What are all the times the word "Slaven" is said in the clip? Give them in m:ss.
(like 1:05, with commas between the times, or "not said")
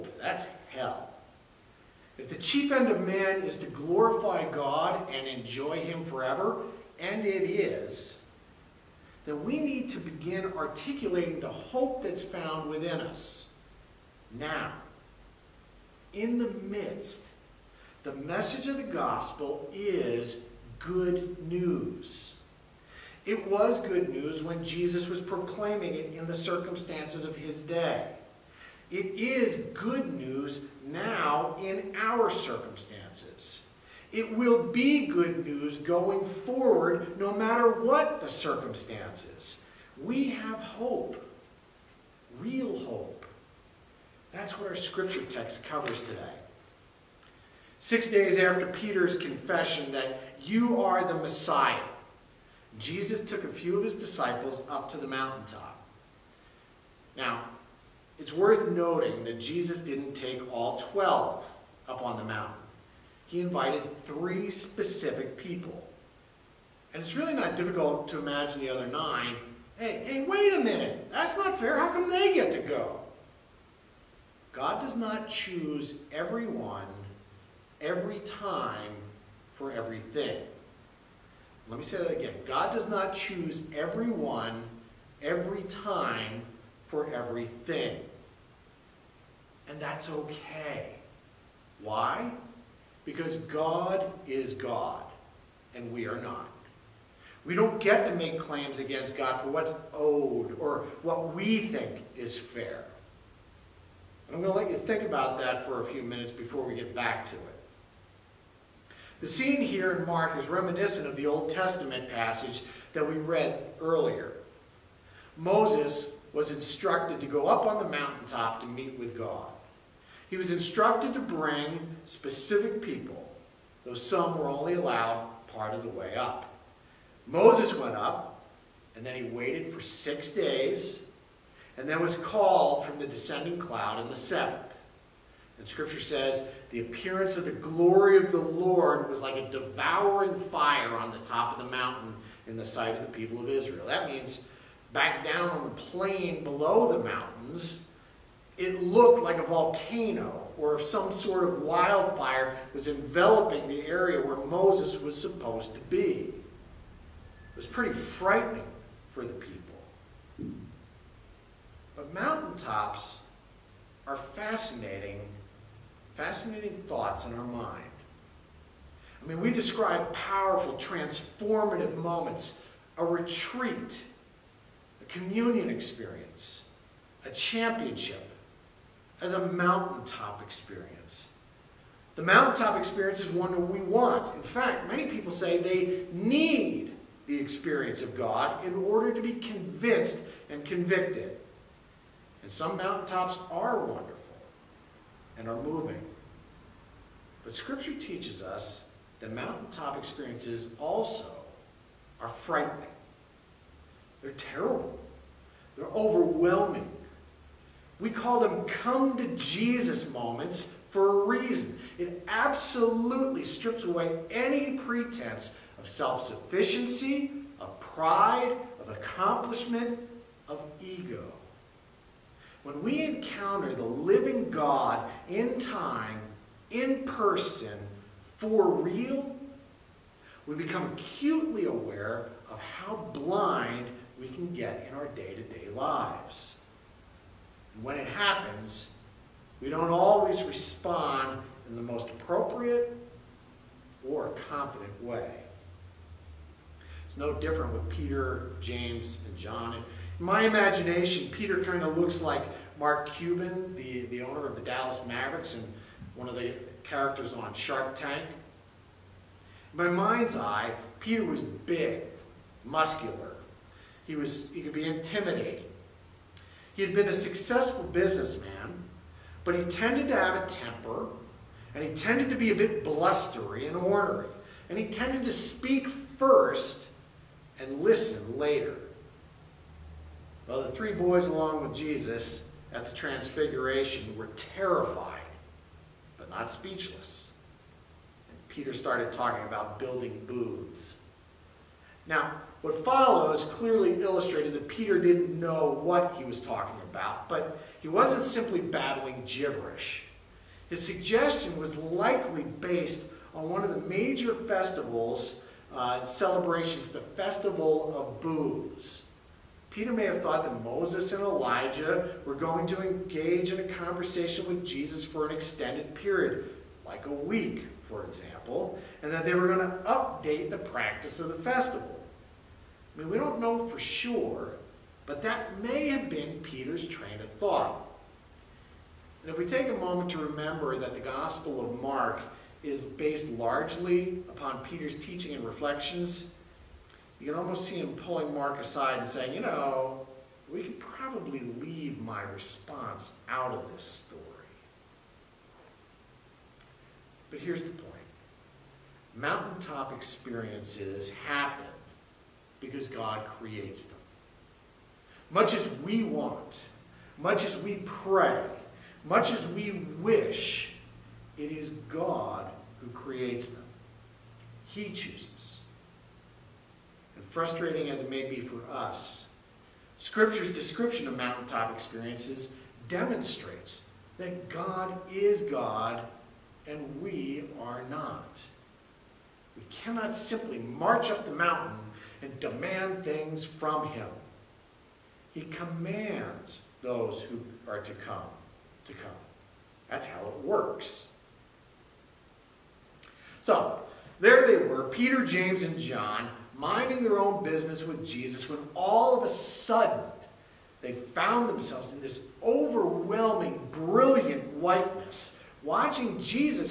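not said.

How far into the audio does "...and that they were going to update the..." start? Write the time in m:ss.
5:19.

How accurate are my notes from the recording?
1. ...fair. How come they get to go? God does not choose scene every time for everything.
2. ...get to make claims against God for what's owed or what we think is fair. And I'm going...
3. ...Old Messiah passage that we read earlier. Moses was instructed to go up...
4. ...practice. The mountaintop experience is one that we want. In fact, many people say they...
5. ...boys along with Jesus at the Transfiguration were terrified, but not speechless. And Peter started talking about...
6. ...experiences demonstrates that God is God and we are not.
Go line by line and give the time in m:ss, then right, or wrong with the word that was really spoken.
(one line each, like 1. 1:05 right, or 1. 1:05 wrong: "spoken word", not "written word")
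1. 1:11 wrong: "everyone", not "scene"
2. 1:37 right
3. 1:51 wrong: "Testament", not "Messiah"
4. 3:00 wrong: "experience", not "practice"
5. 4:40 right
6. 6:11 right.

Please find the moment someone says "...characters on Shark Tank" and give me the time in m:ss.
4:16.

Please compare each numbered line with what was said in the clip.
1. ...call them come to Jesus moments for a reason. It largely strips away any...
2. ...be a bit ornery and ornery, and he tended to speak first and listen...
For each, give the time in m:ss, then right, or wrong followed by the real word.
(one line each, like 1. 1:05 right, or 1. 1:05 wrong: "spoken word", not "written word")
1. 3:28 wrong: "absolutely", not "largely"
2. 4:32 wrong: "blustery", not "ornery".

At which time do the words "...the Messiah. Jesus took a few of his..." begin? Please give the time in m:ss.
0:51.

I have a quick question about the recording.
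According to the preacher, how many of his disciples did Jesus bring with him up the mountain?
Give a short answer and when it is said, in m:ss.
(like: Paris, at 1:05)
3, at 1:04.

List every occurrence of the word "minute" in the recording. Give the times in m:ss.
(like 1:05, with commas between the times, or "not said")
1:10, 1:46.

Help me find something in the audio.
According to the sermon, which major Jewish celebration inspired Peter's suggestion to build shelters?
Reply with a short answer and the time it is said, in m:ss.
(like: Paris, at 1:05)
Festival of Booths, at 5:06.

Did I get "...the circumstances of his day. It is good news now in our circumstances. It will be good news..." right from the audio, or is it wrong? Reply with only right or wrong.
right.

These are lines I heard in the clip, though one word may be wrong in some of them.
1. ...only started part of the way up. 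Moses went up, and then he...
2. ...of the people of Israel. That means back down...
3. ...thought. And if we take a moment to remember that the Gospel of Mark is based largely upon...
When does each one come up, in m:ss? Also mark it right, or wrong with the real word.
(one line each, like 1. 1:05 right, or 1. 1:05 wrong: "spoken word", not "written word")
1. 2:04 wrong: "allowed", not "started"
2. 2:22 right
3. 5:27 right.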